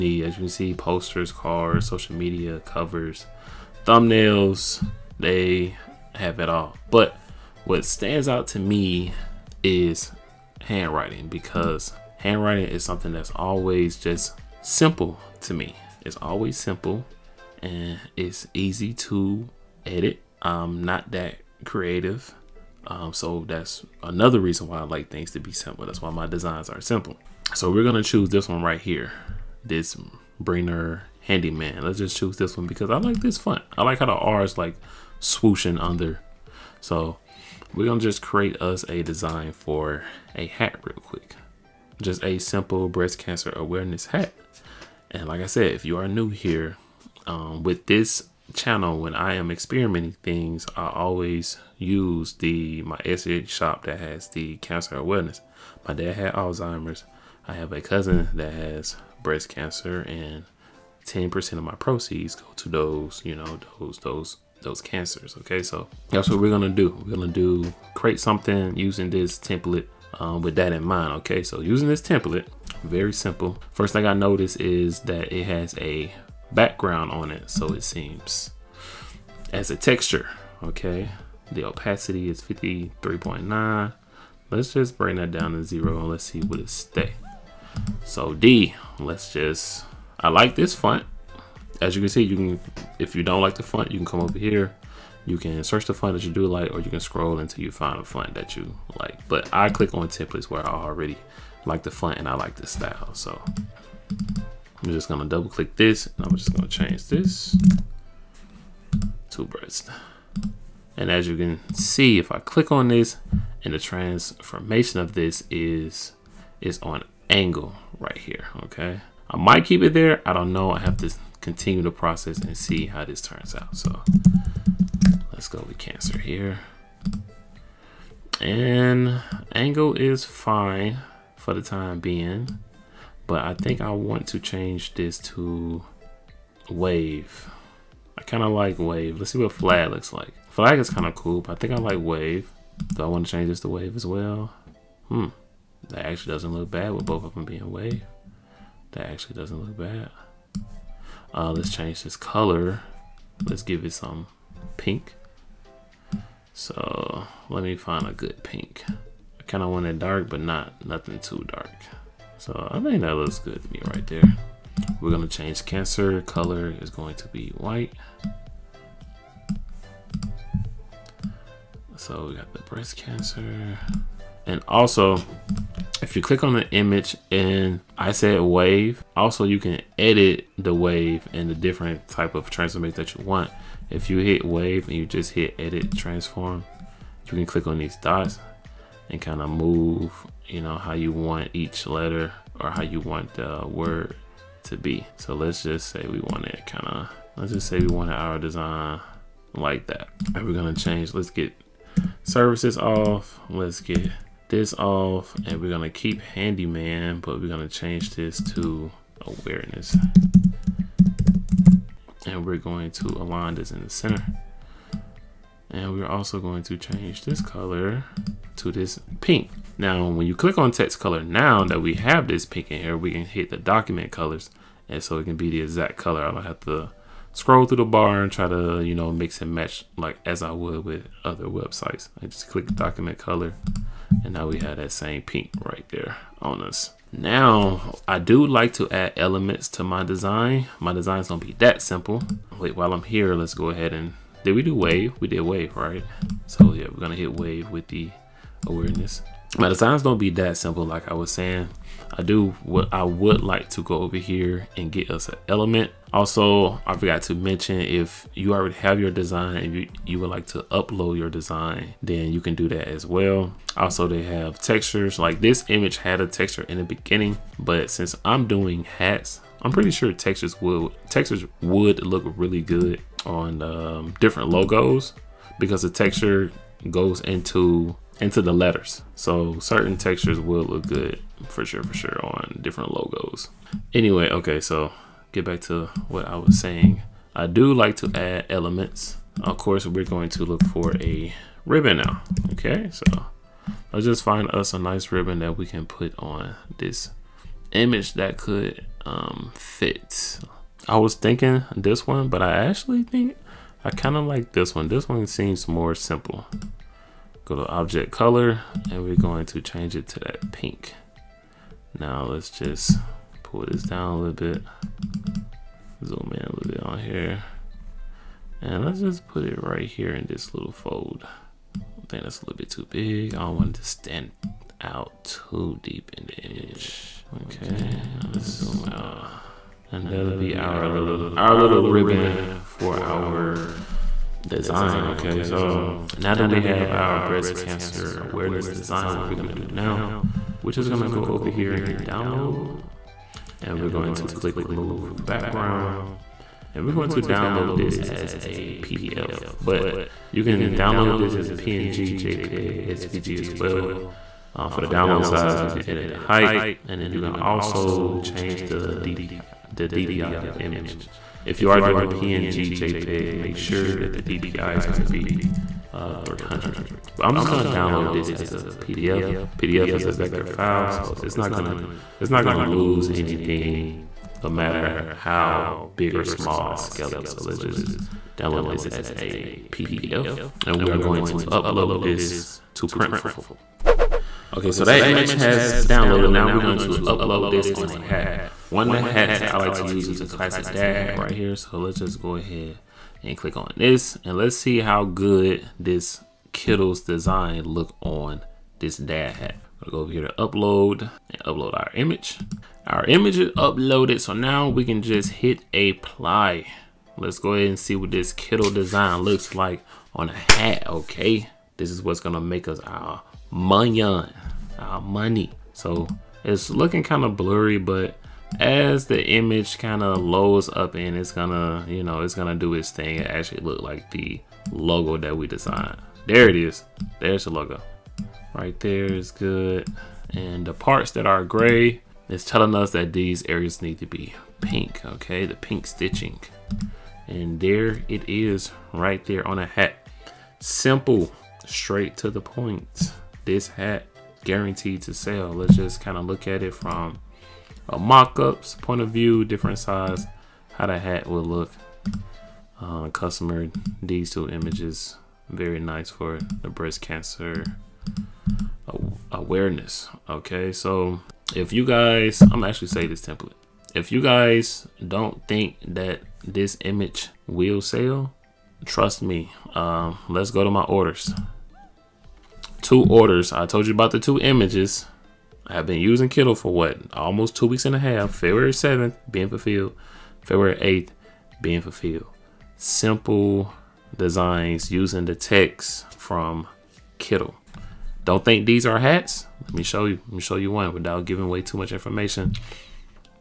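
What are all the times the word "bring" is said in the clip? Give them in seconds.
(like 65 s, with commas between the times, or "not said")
84 s.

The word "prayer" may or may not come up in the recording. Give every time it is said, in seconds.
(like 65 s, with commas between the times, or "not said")
not said.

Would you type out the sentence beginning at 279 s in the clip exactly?
So certain textures will look good for sure, for sure on different logos.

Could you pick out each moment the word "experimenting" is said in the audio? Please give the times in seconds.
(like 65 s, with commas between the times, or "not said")
49 s.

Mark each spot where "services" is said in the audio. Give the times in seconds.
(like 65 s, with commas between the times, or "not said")
202 s.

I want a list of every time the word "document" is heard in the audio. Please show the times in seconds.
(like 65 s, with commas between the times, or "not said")
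223 s, 232 s.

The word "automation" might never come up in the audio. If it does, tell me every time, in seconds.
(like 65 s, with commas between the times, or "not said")
not said.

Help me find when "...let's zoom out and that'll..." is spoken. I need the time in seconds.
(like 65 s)
328 s.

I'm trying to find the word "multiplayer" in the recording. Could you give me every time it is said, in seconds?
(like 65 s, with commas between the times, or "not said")
not said.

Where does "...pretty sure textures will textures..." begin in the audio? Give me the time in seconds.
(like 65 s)
269 s.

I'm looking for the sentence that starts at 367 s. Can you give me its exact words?
But I'm just going to download this as a PDF.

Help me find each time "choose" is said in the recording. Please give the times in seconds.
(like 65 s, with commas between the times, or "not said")
28 s, 32 s.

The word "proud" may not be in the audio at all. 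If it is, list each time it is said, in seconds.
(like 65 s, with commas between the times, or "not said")
not said.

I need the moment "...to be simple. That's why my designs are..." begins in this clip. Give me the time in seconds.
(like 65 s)
25 s.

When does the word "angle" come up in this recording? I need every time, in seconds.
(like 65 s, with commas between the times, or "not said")
117 s, 129 s.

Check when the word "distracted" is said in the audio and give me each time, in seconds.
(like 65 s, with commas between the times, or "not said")
not said.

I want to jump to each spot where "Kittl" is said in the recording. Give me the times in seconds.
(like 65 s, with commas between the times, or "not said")
396 s, 408 s, 476 s, 487 s.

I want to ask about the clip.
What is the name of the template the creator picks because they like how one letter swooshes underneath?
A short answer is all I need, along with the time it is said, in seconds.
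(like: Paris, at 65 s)
Brainer Handyman, at 30 s.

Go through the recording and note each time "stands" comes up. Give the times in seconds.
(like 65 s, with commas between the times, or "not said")
7 s, 323 s.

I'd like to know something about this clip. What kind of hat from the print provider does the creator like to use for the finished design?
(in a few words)
classic dad hat.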